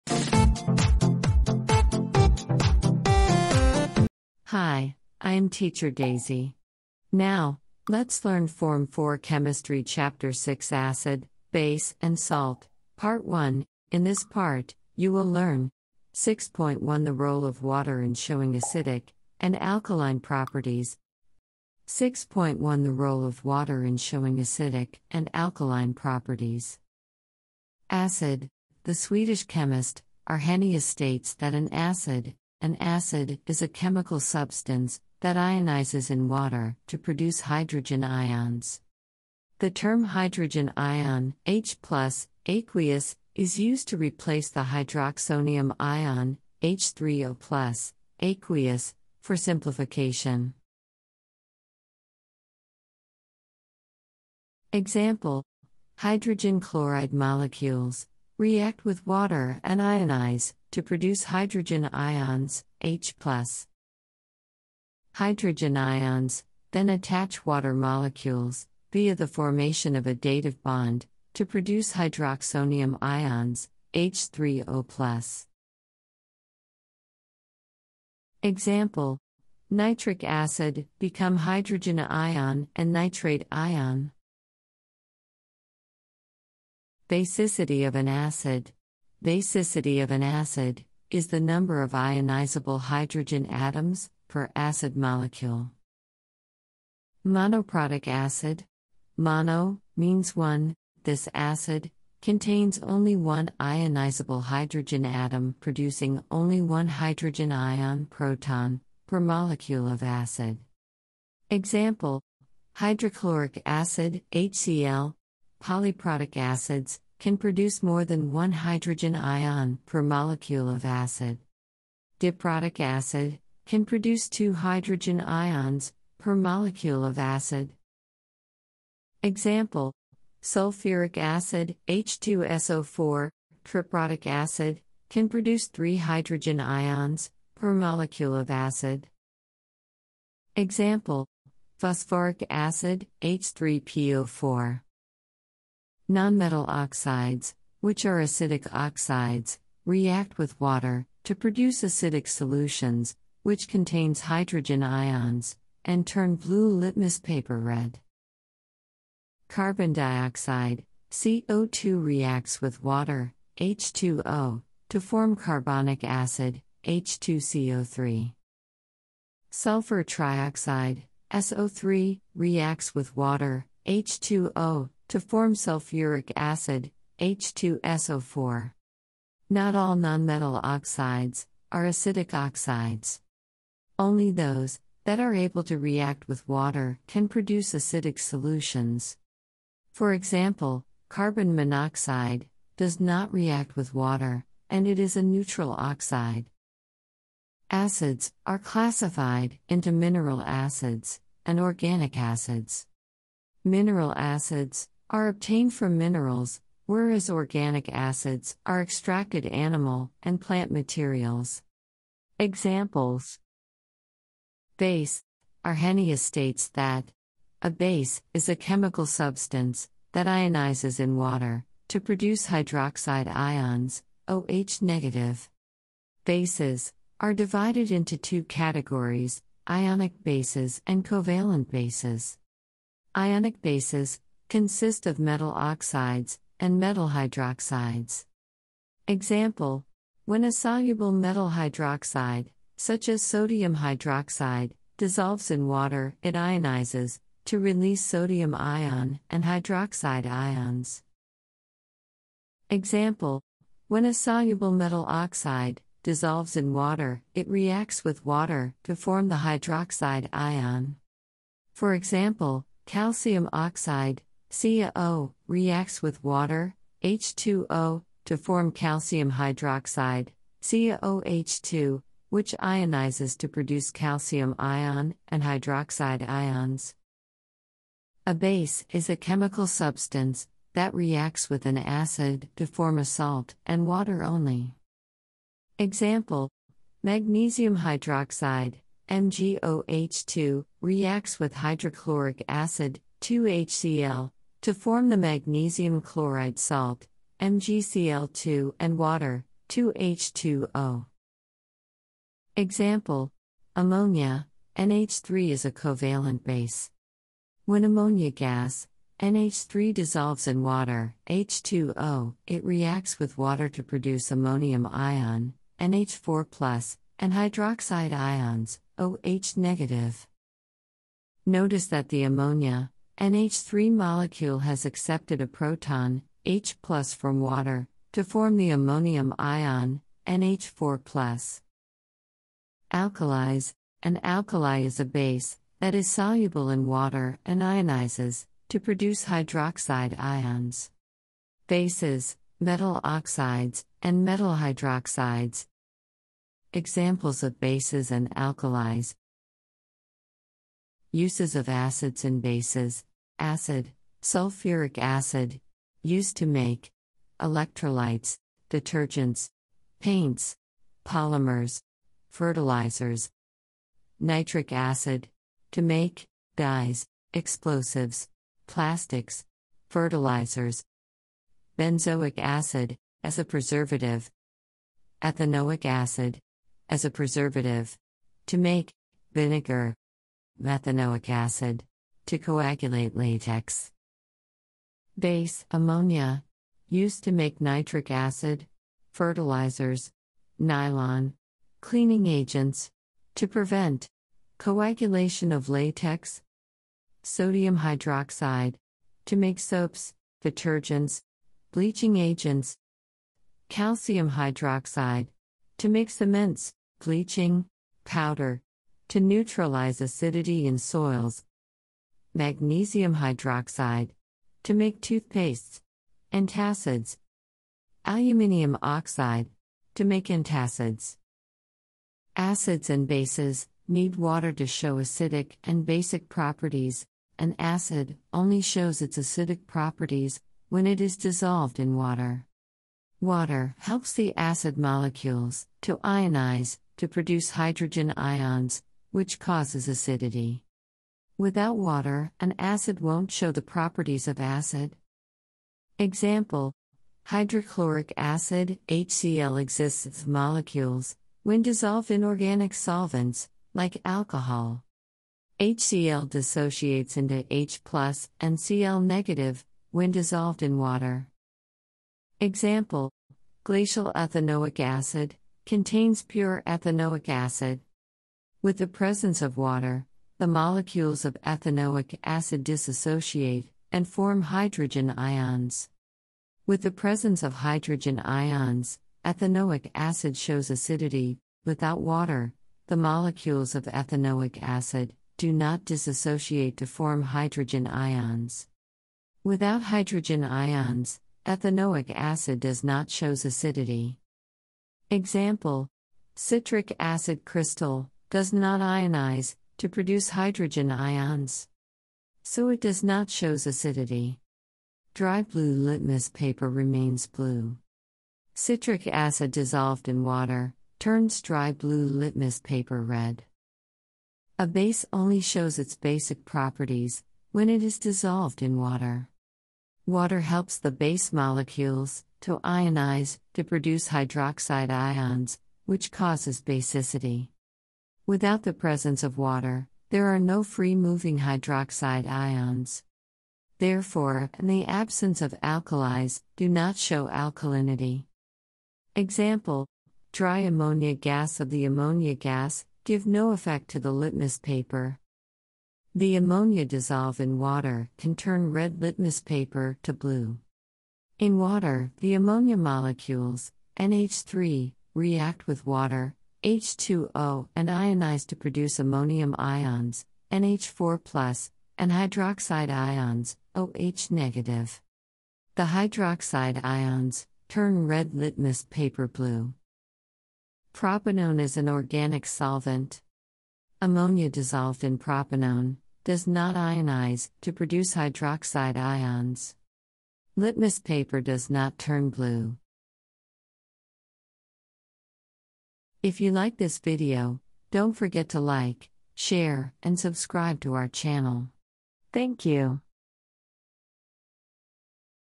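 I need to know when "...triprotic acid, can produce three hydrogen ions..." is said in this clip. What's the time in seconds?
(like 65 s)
133 s.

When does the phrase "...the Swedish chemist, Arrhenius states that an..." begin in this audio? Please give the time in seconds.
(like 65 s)
28 s.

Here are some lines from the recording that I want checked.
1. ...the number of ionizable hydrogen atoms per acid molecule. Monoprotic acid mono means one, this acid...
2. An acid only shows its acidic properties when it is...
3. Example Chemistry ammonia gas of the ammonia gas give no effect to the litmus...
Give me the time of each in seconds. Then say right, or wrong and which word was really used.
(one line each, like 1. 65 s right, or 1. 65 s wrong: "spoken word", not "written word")
1. 91 s right
2. 427 s right
3. 539 s wrong: "Dry", not "Chemistry".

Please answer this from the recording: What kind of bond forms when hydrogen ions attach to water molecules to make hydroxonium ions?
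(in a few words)
Dative bond.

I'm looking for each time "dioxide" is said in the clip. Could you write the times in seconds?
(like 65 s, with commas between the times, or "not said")
159 s.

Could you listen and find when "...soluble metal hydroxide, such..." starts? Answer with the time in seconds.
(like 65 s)
240 s.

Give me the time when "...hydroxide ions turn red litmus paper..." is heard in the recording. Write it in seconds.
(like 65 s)
565 s.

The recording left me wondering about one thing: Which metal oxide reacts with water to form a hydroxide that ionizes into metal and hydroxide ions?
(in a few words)
Calcium oxide.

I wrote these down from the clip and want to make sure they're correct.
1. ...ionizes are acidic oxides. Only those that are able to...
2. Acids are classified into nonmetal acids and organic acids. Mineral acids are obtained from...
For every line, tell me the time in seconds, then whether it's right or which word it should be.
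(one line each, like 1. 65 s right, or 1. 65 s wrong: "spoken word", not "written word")
1. 180 s wrong: "oxides", not "ionizes"
2. 197 s wrong: "mineral", not "nonmetal".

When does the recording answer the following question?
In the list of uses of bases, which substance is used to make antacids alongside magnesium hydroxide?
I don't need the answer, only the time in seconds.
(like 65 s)
418 s.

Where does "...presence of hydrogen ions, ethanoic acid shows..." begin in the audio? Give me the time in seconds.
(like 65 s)
476 s.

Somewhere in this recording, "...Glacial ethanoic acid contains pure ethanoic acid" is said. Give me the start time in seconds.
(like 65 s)
463 s.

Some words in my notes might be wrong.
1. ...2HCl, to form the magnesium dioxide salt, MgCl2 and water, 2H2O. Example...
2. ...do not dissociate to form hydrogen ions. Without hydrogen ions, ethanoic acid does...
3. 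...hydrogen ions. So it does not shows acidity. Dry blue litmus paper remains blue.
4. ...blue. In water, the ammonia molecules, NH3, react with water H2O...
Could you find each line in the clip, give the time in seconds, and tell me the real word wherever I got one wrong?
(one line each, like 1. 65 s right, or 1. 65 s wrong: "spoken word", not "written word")
1. 293 s wrong: "chloride", not "dioxide"
2. 485 s right
3. 500 s right
4. 550 s right.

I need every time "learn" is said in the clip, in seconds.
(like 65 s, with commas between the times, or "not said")
8 s, 15 s.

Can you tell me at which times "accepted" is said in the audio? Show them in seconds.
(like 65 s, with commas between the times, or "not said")
324 s.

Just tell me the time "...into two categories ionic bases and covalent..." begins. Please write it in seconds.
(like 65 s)
227 s.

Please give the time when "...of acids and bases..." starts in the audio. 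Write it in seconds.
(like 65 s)
351 s.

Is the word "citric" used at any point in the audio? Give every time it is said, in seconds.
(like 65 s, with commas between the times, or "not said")
496 s, 508 s.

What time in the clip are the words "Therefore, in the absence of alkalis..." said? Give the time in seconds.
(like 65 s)
533 s.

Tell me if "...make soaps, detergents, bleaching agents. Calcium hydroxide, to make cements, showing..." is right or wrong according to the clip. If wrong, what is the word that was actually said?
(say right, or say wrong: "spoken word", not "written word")
wrong: "bleaching", not "showing".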